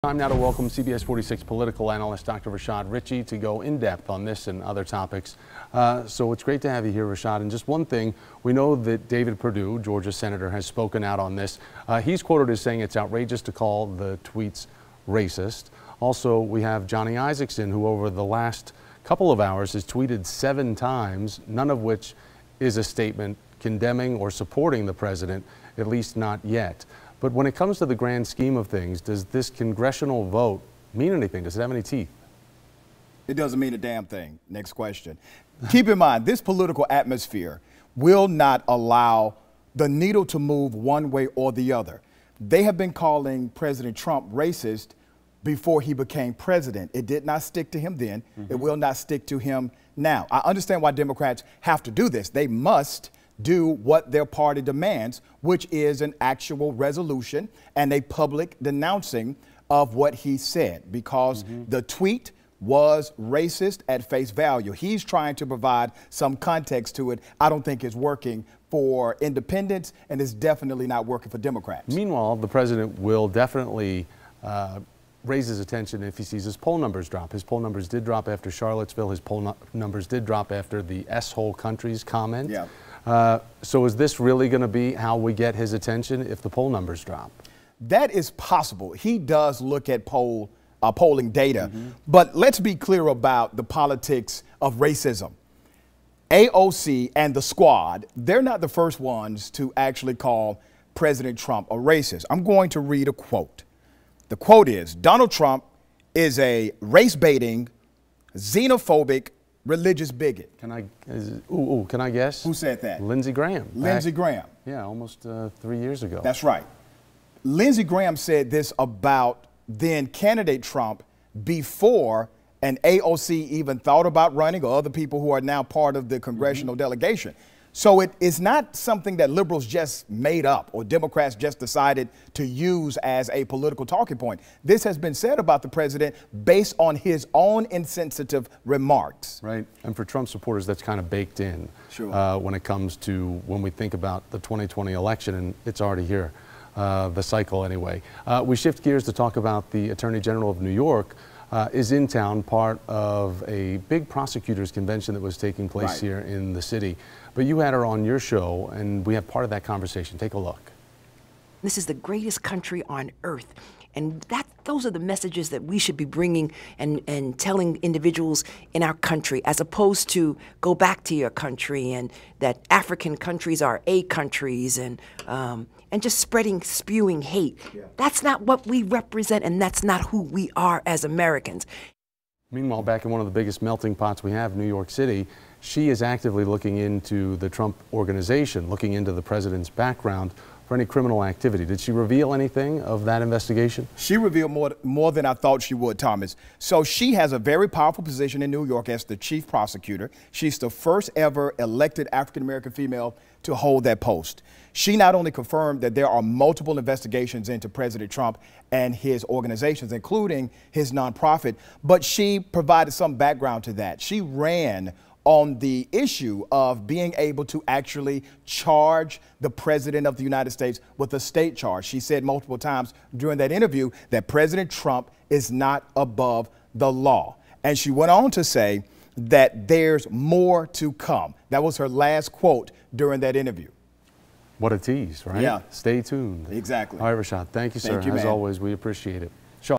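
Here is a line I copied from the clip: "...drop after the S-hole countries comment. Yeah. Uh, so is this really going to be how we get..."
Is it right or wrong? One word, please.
right.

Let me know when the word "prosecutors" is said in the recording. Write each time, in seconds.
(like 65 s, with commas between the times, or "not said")
154 s, 199 s.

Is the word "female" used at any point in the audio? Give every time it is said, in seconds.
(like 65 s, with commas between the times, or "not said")
202 s.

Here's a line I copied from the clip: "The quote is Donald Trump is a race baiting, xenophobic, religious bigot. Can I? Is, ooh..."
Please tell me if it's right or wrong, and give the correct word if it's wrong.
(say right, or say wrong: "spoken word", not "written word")
right.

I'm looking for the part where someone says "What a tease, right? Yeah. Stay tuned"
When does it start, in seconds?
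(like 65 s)
234 s.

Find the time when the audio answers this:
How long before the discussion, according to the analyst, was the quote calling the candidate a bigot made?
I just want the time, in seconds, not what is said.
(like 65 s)
114 s.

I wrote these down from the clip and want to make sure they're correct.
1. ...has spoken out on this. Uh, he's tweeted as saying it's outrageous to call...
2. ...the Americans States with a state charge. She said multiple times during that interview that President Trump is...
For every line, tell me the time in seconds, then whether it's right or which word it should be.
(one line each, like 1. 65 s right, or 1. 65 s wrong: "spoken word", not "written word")
1. 10 s wrong: "quoted", not "tweeted"
2. 220 s wrong: "United", not "Americans".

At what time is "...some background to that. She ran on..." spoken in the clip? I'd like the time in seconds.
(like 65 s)
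212 s.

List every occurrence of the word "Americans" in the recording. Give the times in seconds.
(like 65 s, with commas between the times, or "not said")
181 s, 202 s.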